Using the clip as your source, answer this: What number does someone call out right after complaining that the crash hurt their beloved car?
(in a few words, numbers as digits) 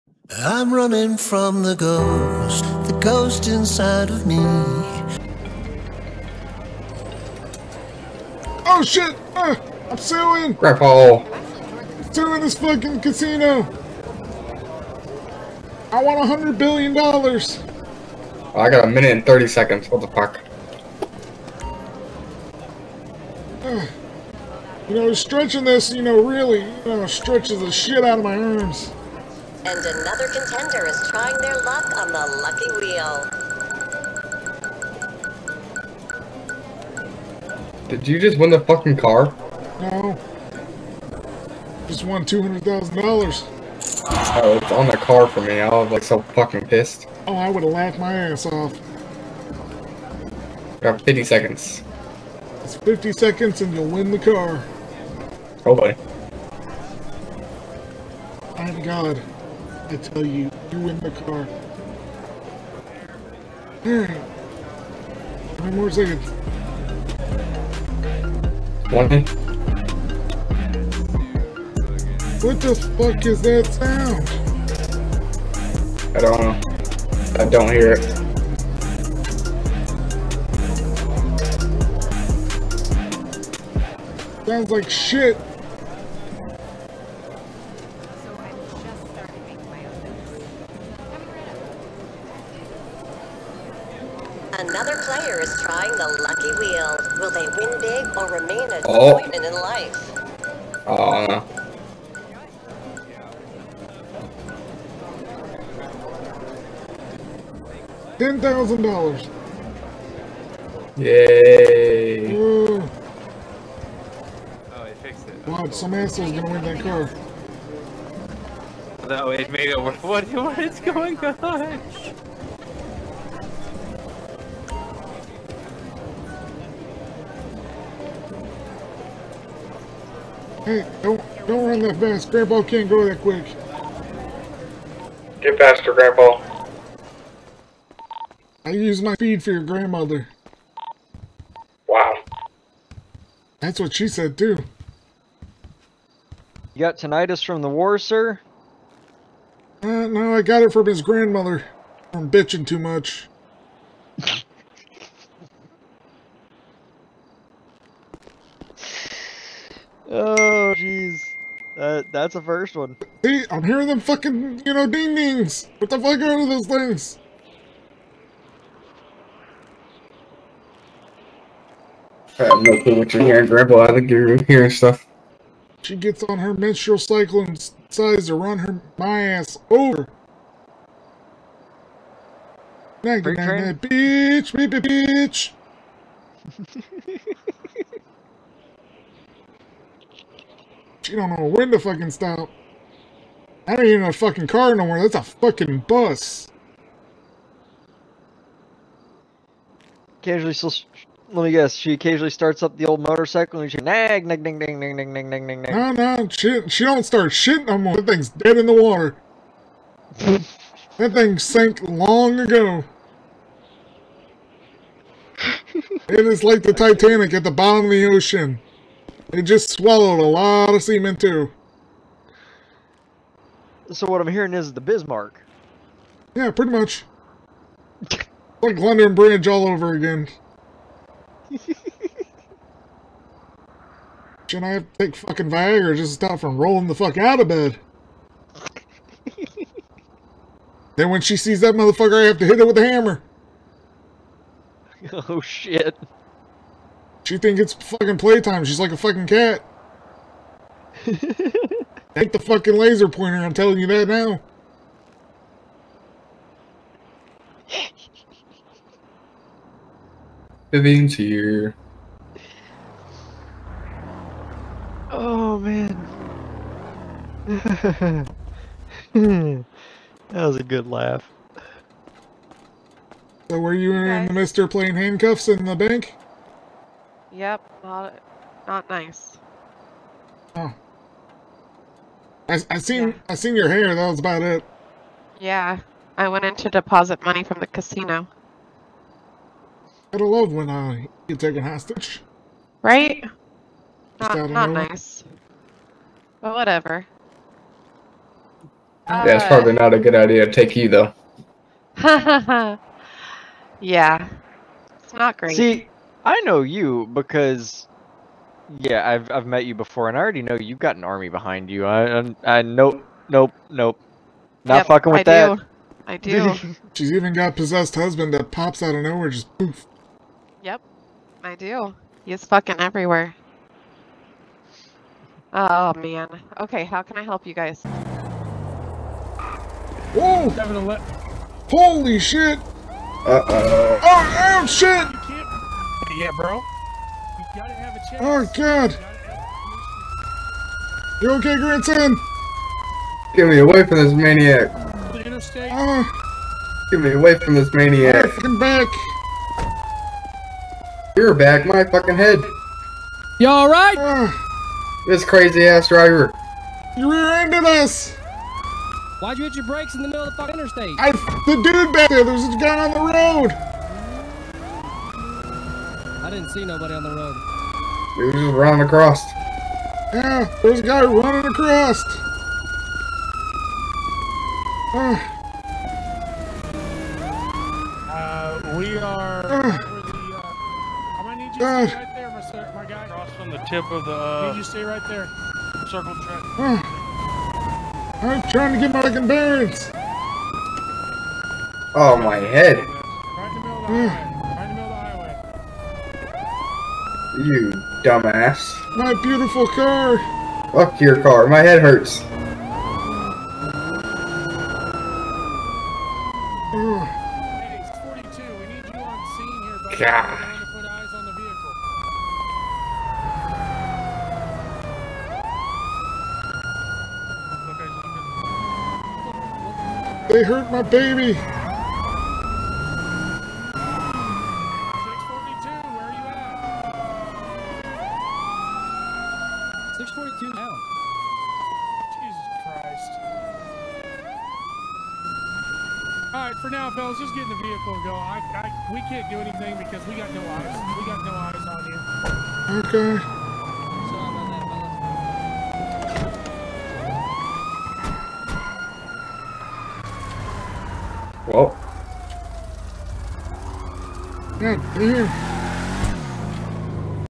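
642.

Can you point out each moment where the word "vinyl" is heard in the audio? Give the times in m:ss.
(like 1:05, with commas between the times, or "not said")
not said.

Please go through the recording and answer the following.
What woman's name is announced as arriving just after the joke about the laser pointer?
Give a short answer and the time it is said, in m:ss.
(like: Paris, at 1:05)
Vivian, at 4:20.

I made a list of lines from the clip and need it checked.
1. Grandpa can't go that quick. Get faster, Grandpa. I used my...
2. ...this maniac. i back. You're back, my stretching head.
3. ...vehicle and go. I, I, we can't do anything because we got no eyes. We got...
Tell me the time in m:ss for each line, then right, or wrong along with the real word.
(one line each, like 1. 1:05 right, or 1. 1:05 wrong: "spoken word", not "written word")
1. 2:12 right
2. 5:47 wrong: "fucking", not "stretching"
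3. 7:17 right.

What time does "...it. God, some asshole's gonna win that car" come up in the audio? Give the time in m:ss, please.
1:55.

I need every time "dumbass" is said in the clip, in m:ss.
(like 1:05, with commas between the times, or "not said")
6:38.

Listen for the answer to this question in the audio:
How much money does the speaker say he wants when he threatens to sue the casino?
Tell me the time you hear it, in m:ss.
0:16.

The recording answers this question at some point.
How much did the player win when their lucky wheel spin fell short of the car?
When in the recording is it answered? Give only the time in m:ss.
1:48.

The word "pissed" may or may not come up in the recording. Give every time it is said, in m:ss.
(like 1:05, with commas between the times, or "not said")
0:46.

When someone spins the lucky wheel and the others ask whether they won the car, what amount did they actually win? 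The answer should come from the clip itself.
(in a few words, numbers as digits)
$200,000.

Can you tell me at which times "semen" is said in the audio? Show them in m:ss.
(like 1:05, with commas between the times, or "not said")
3:40.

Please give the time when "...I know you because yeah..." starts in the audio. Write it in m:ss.
5:06.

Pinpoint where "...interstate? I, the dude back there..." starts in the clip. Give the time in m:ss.
6:00.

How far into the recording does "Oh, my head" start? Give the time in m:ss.
6:31.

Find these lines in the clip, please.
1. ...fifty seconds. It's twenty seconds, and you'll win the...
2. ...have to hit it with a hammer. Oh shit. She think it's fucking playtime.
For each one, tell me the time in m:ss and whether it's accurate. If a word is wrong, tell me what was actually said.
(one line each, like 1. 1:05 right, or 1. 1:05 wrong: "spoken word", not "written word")
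1. 0:51 wrong: "fifty", not "twenty"
2. 4:02 right.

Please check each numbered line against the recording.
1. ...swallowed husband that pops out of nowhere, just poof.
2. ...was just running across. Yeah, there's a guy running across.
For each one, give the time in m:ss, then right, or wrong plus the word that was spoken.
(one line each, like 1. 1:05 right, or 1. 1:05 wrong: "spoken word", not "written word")
1. 5:17 wrong: "possessed", not "swallowed"
2. 6:08 right.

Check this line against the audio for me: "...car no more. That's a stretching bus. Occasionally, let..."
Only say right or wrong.
wrong.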